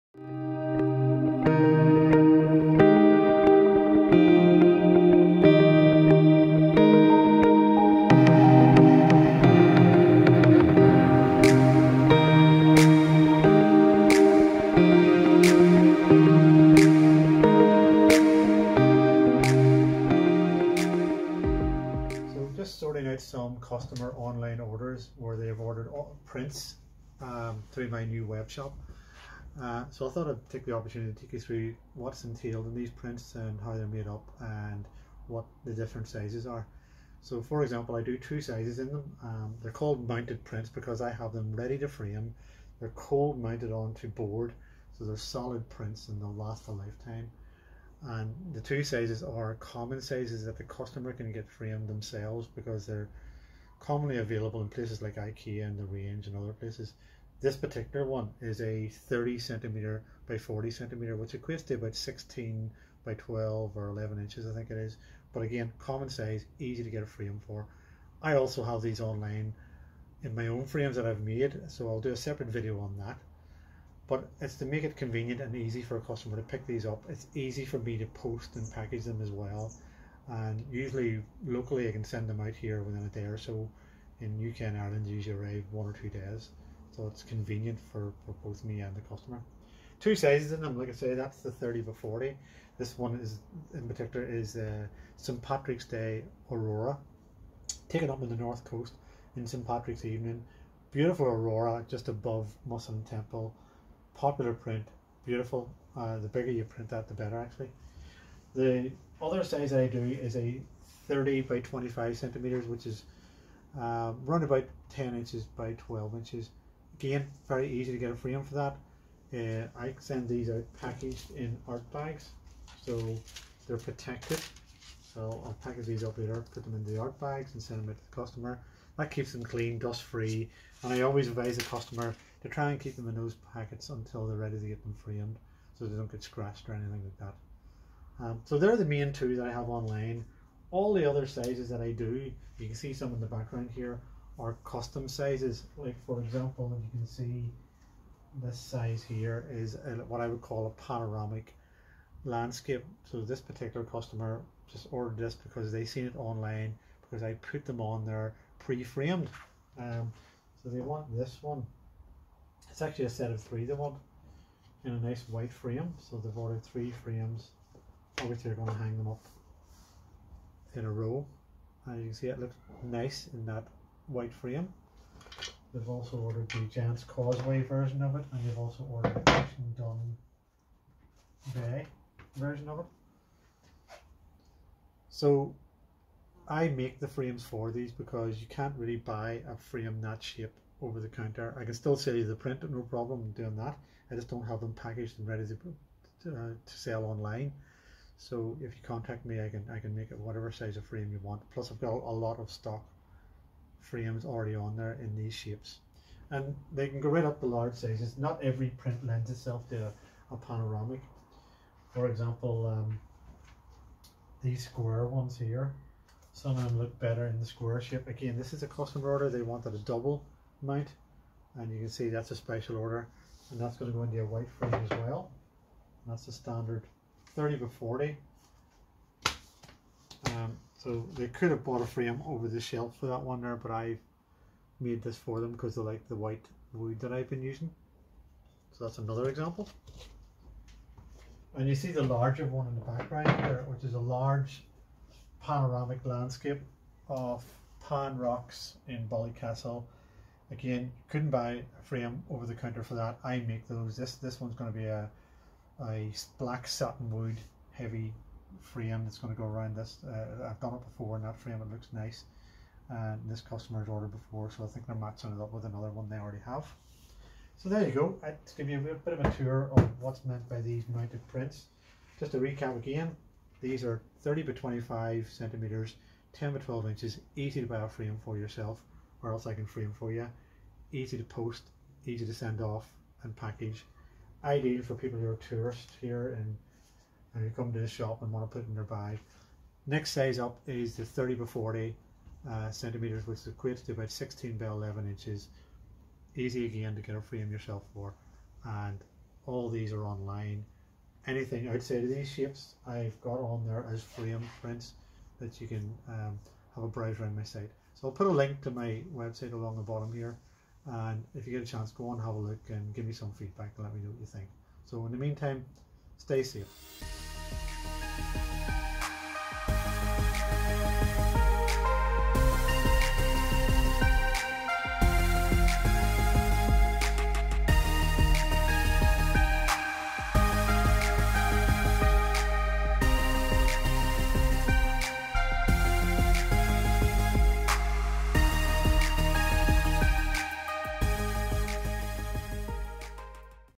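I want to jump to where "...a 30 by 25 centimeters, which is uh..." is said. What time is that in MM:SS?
01:50.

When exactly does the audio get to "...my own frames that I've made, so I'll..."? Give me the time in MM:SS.
01:10.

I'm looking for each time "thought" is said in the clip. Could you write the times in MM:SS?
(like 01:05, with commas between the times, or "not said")
00:30.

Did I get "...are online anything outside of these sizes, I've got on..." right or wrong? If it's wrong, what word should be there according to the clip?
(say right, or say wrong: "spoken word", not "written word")
wrong: "shapes", not "sizes".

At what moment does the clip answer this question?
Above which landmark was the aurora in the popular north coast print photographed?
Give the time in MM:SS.
01:42.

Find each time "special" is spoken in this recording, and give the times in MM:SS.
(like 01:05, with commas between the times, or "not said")
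03:42.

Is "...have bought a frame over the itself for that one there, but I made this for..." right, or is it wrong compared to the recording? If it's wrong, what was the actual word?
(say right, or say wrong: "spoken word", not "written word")
wrong: "shelf", not "itself".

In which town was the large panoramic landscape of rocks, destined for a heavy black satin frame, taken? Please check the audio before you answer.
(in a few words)
Ballycastle.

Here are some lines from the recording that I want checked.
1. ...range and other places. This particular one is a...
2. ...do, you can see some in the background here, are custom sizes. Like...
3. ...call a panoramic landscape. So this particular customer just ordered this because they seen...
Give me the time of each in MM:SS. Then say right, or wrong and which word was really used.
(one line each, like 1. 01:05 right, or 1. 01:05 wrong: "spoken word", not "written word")
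1. 00:55 right
2. 02:21 right
3. 02:30 right.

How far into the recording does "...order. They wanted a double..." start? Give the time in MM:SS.
03:39.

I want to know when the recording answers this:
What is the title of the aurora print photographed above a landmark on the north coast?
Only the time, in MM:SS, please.
01:35.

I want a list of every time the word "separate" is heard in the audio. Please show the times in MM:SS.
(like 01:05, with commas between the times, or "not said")
01:12.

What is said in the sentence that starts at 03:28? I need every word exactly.
Not every print lends itself to a, a panoramic.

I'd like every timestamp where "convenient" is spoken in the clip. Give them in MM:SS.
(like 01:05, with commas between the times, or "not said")
01:14, 01:27.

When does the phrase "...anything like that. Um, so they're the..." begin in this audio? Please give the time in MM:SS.
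02:16.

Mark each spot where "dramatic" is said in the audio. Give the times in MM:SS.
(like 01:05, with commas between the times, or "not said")
not said.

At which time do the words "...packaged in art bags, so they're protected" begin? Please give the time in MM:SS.
02:00.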